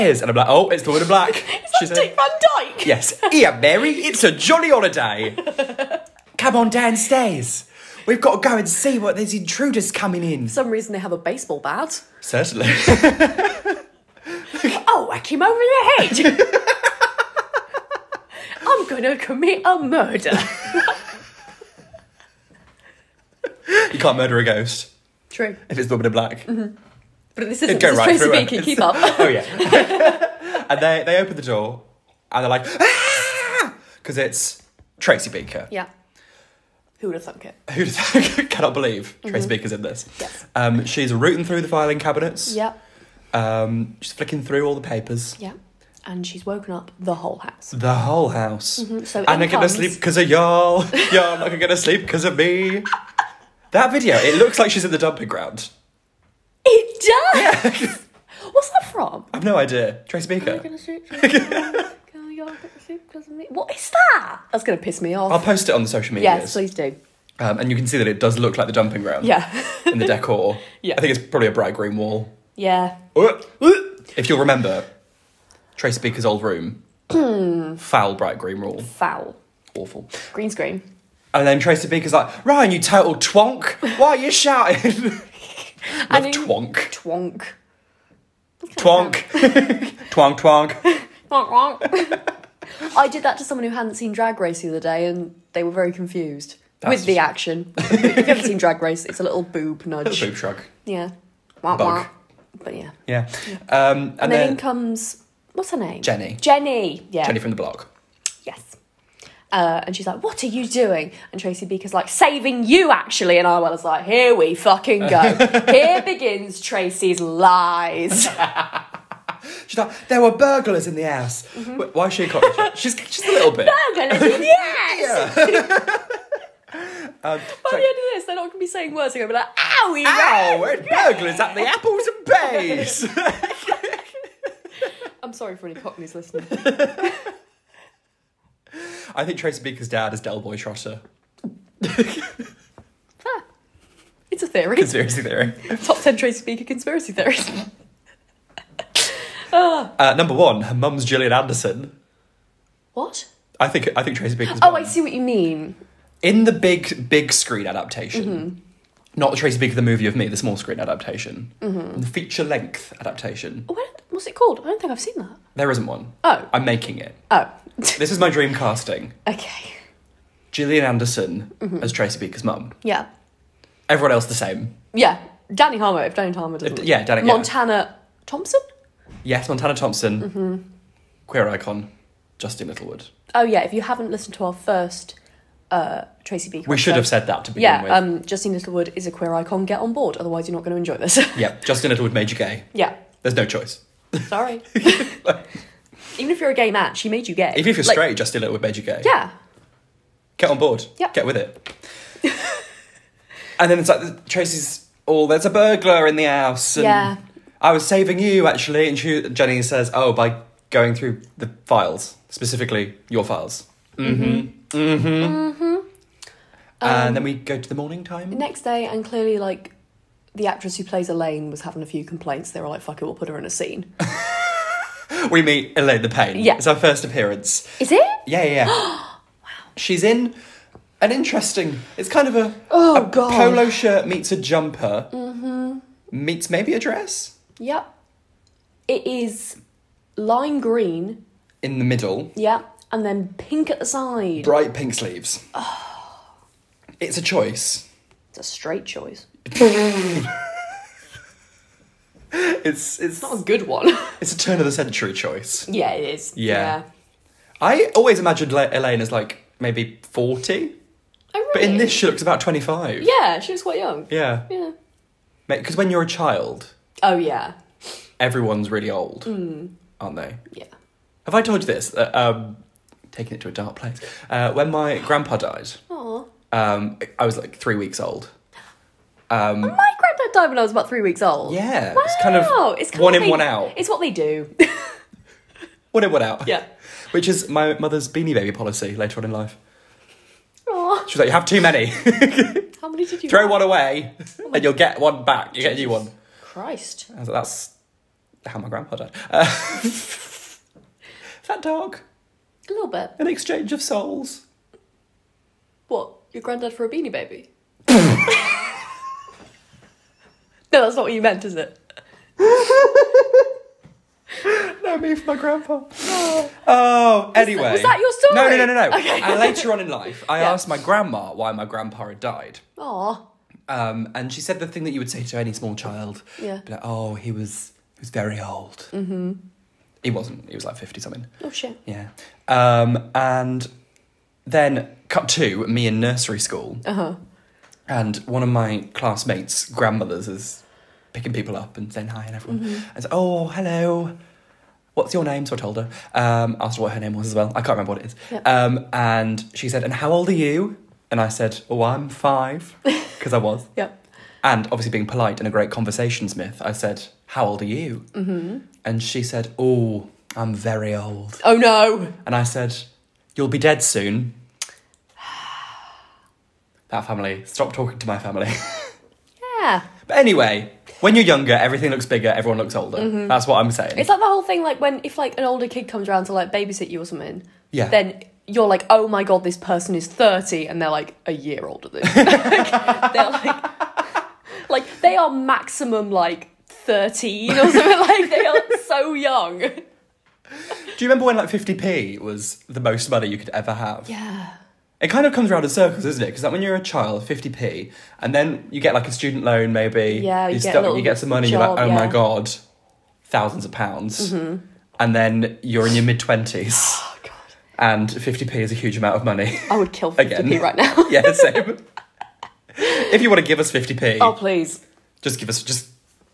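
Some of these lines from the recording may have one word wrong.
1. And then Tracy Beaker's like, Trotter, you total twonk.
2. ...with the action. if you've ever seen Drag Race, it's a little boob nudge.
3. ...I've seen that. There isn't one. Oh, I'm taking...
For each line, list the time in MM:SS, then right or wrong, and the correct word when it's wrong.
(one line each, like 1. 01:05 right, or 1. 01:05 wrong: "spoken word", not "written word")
1. 01:21 wrong: "Ryan", not "Trotter"
2. 01:36 right
3. 02:44 wrong: "making", not "taking".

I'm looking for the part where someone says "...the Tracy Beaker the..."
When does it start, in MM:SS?
02:39.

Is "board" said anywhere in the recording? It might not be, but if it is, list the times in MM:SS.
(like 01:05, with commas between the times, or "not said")
03:09, 03:20.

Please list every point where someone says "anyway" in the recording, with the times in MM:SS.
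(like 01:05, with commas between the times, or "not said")
05:17, 06:10.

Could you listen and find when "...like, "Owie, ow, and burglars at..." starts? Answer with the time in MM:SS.
02:09.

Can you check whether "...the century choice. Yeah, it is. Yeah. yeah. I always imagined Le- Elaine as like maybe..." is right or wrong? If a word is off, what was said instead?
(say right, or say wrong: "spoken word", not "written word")
right.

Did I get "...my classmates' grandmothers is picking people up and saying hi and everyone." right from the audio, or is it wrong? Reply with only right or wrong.
right.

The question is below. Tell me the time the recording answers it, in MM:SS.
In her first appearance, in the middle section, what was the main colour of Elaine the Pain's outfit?
04:00.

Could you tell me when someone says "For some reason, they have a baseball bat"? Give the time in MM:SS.
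00:10.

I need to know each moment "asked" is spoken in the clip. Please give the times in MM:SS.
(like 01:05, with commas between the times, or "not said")
05:20, 05:46.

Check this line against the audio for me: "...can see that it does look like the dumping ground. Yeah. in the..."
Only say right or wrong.
right.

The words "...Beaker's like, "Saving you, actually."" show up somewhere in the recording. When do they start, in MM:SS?
01:51.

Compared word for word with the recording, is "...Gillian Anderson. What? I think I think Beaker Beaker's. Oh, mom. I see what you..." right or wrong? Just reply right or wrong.
wrong.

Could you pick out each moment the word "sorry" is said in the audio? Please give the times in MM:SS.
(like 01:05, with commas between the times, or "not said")
02:15, 03:14.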